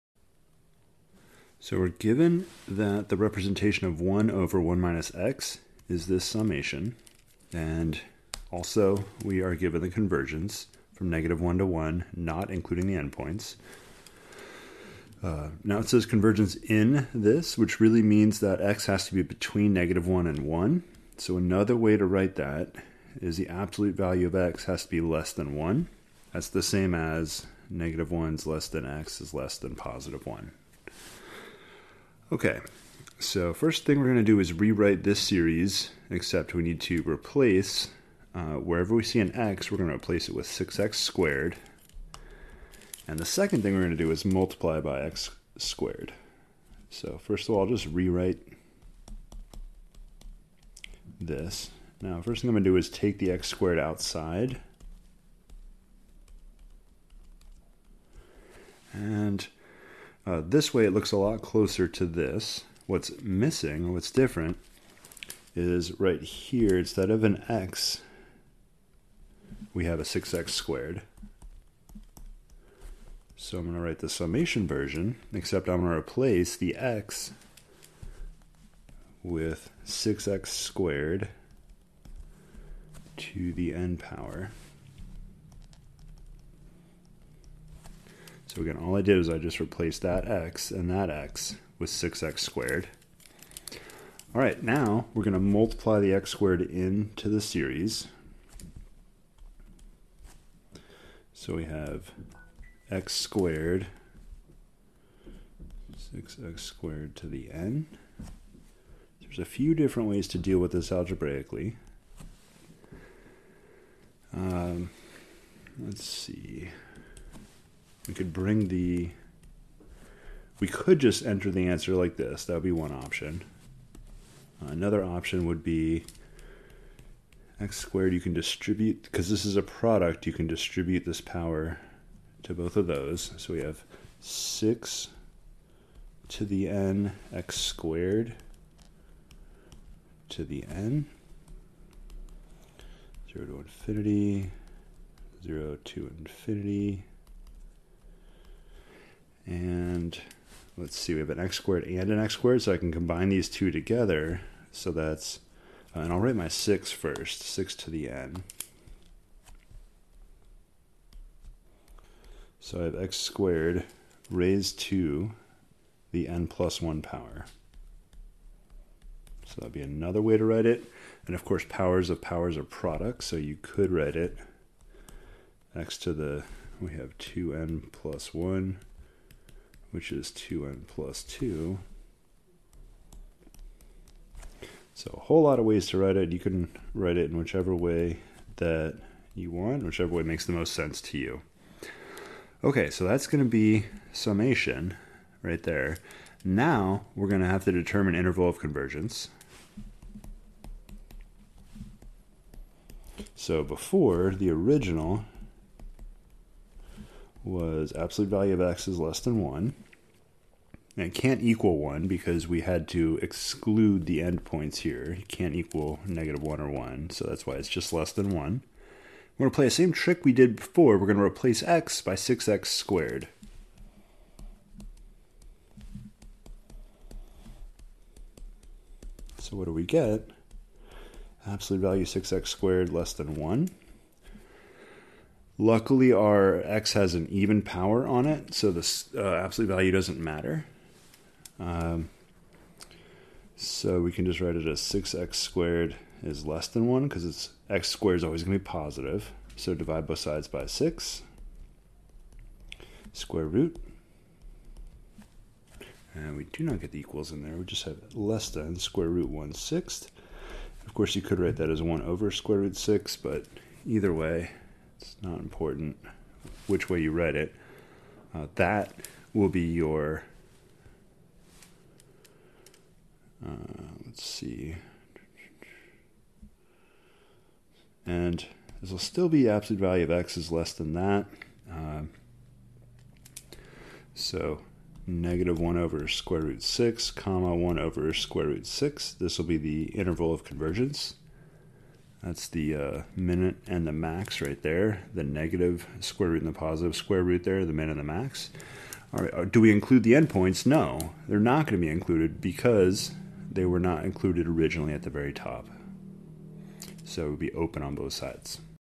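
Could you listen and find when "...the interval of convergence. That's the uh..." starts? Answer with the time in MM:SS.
04:49.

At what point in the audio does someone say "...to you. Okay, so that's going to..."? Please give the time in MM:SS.
03:11.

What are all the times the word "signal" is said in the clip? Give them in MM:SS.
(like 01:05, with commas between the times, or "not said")
not said.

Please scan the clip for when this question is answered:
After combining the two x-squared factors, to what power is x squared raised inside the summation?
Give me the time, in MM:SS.
02:46.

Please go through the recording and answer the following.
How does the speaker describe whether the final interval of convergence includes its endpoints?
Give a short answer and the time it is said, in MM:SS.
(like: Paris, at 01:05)
open on both sides, at 05:07.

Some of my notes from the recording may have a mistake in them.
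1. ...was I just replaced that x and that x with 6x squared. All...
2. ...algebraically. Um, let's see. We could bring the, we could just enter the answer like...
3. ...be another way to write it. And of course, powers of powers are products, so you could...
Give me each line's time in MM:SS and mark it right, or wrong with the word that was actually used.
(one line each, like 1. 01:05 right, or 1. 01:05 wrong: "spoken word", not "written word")
1. 01:29 right
2. 01:50 right
3. 02:49 right.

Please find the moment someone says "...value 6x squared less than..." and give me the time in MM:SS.
03:51.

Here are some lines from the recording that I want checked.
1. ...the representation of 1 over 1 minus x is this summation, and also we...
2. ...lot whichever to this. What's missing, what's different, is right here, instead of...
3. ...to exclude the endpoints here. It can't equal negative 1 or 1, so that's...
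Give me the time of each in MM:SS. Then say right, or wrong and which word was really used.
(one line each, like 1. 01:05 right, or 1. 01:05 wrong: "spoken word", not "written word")
1. 00:03 right
2. 01:01 wrong: "closer", not "whichever"
3. 03:32 right.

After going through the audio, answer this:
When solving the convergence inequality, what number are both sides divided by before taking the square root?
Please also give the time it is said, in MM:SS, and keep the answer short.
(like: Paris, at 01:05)
6, at 04:09.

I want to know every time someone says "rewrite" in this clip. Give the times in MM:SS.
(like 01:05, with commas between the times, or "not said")
00:34, 00:47.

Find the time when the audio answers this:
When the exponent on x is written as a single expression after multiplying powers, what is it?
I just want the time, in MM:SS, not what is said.
03:00.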